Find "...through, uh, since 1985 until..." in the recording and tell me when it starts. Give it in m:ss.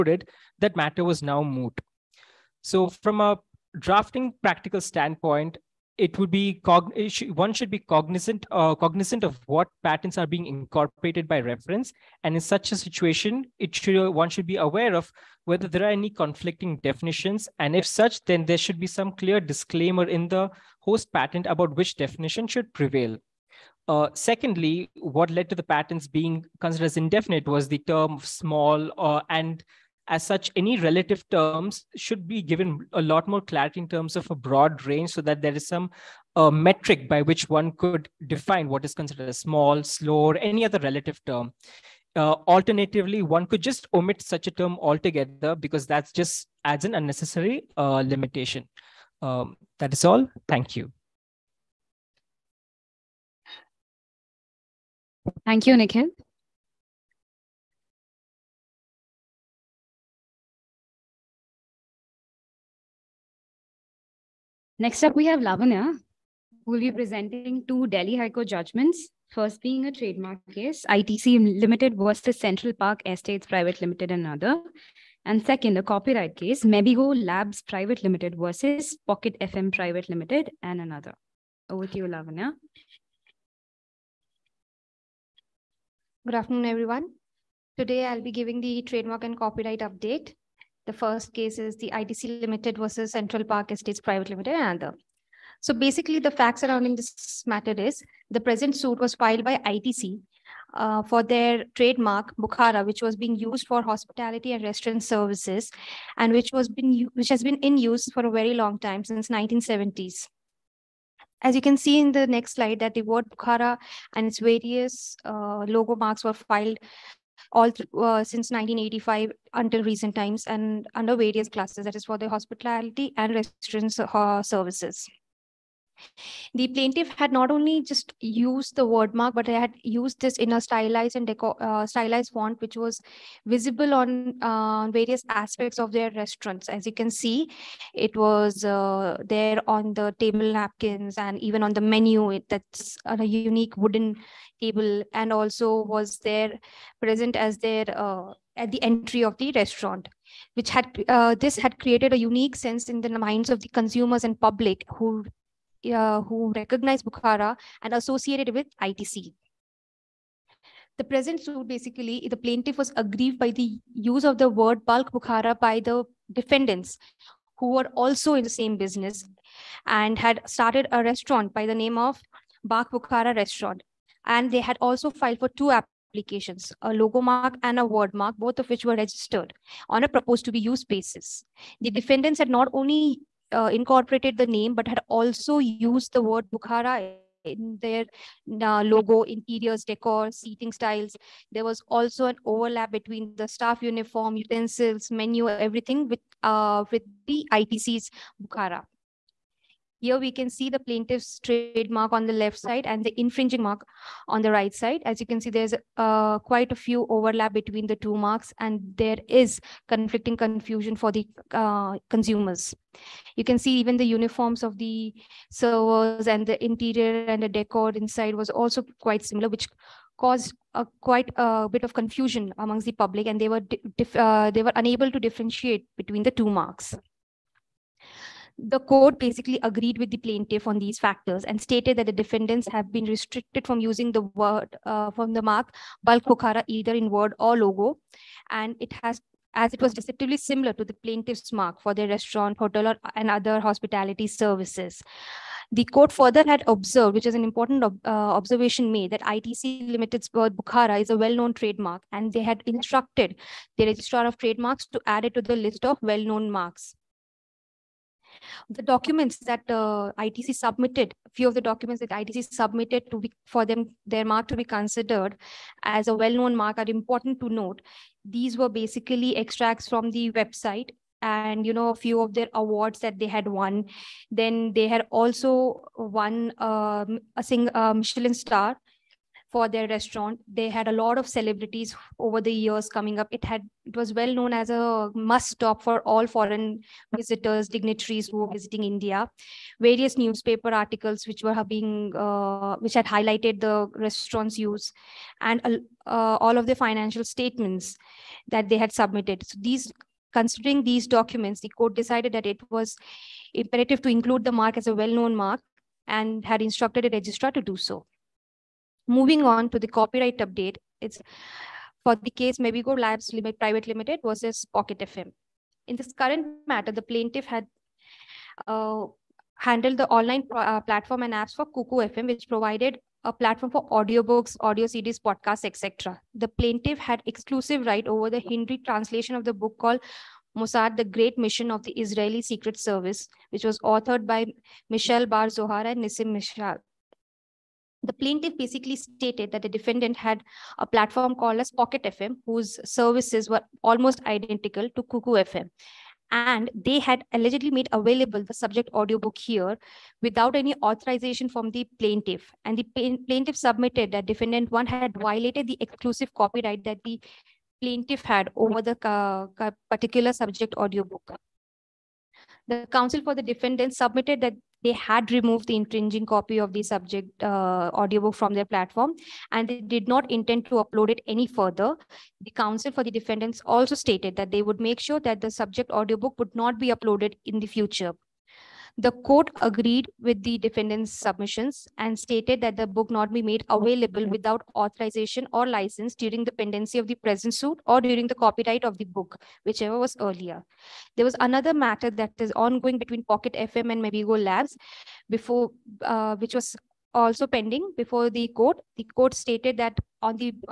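1:57.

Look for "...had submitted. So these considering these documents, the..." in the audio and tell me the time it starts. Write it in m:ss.
4:58.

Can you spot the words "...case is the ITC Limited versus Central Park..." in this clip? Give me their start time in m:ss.
1:31.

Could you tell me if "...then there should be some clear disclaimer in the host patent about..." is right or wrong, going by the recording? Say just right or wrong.
right.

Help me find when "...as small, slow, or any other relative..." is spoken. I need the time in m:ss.
0:39.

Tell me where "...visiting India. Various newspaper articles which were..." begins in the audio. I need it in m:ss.
4:48.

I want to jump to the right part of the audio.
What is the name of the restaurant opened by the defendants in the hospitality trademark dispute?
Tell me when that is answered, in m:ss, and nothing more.
2:52.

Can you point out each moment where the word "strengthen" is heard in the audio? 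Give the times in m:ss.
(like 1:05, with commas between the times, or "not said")
not said.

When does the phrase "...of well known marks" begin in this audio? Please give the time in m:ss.
4:15.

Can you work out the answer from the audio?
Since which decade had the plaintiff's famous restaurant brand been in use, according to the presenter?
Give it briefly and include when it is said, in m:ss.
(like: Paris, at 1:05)
1970s, at 1:49.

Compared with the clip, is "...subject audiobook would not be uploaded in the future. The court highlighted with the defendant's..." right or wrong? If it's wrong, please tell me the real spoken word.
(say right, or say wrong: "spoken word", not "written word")
wrong: "agreed", not "highlighted".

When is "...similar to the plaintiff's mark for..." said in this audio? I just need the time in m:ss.
4:00.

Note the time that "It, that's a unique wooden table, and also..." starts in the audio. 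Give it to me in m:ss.
2:22.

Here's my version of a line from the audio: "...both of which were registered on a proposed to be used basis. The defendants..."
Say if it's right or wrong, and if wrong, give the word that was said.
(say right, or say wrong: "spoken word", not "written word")
right.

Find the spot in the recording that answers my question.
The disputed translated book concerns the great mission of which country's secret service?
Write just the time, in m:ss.
5:31.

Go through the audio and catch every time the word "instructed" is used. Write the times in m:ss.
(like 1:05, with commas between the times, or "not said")
4:12, 5:06.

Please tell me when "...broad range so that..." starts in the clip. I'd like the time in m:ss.
0:34.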